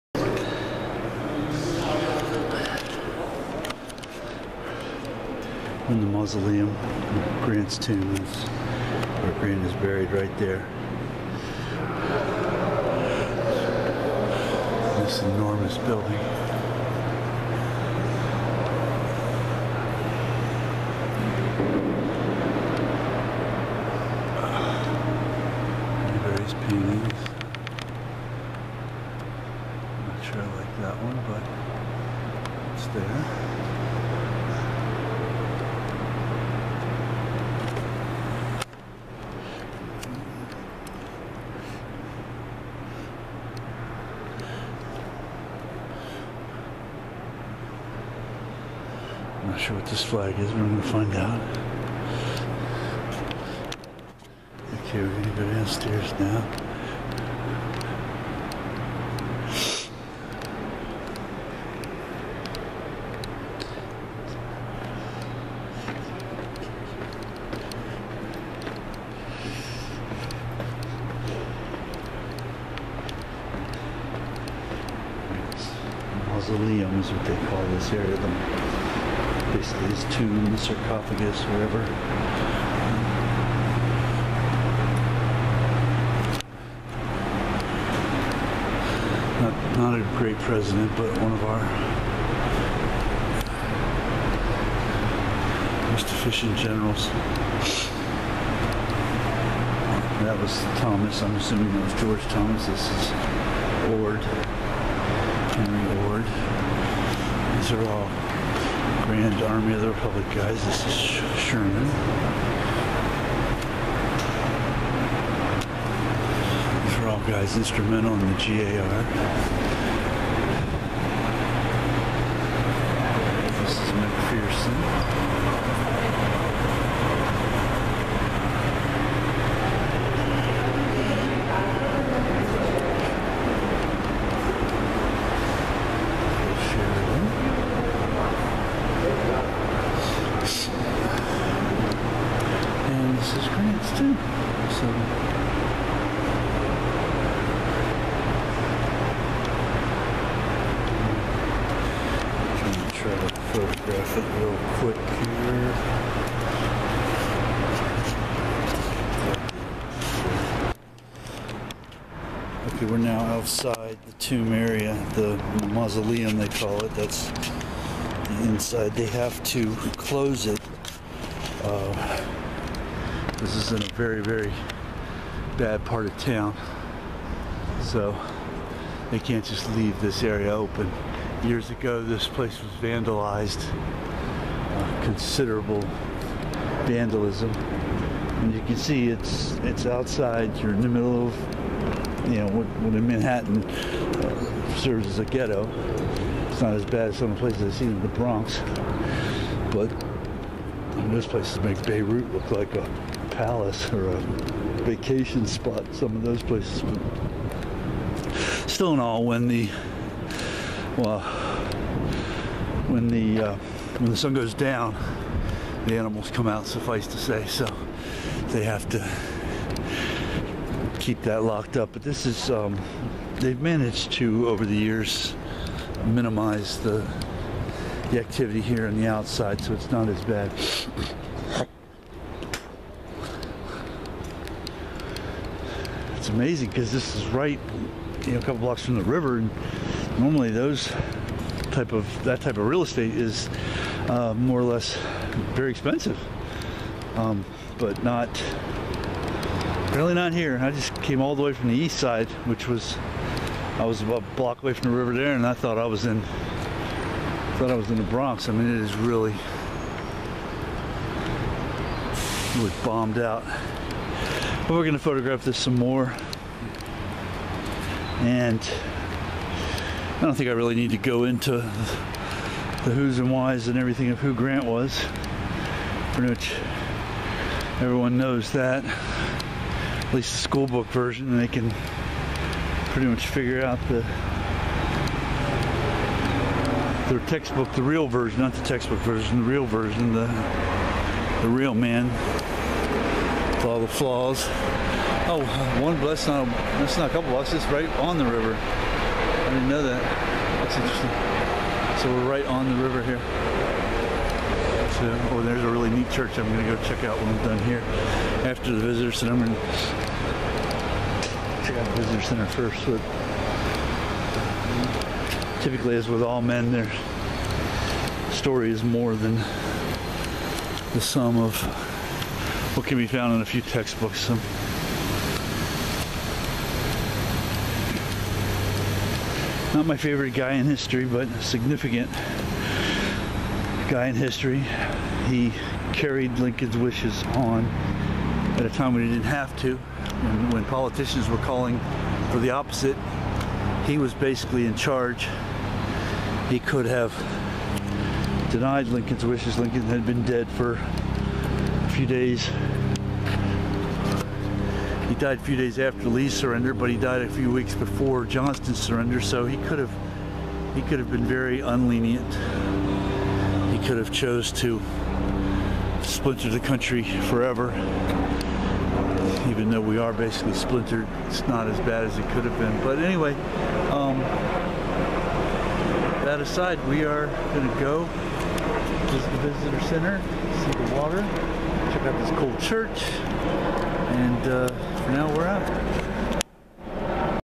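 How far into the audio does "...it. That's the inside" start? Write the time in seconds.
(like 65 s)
166 s.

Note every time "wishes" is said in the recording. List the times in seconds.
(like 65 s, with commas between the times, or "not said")
336 s, 349 s.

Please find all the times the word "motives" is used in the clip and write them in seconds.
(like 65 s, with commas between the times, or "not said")
not said.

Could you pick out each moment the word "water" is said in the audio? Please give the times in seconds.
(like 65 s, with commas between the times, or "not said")
380 s.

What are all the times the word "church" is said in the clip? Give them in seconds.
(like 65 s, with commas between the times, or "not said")
306 s, 382 s.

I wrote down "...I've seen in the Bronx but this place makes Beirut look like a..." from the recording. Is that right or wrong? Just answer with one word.
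right.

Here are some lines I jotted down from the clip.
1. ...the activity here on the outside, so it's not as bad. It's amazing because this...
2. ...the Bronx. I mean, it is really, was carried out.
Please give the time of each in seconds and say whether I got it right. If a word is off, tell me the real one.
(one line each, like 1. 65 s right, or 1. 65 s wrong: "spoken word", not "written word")
1. 228 s right
2. 257 s wrong: "bombed", not "carried".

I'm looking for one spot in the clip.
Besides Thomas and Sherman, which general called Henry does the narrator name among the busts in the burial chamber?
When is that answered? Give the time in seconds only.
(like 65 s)
105 s.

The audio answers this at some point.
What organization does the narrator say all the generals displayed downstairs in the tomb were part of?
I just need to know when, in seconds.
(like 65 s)
109 s.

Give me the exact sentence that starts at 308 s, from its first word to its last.
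After the visitor center, I'm going to check out the visitor center first.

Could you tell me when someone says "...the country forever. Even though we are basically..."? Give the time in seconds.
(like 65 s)
366 s.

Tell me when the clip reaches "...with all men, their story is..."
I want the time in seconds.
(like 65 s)
316 s.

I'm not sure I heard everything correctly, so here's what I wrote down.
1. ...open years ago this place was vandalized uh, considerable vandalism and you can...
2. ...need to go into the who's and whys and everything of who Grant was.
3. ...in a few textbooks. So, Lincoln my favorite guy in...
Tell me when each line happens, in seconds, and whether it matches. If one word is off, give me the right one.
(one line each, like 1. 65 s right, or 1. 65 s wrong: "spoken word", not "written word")
1. 180 s right
2. 270 s right
3. 323 s wrong: "Not", not "Lincoln".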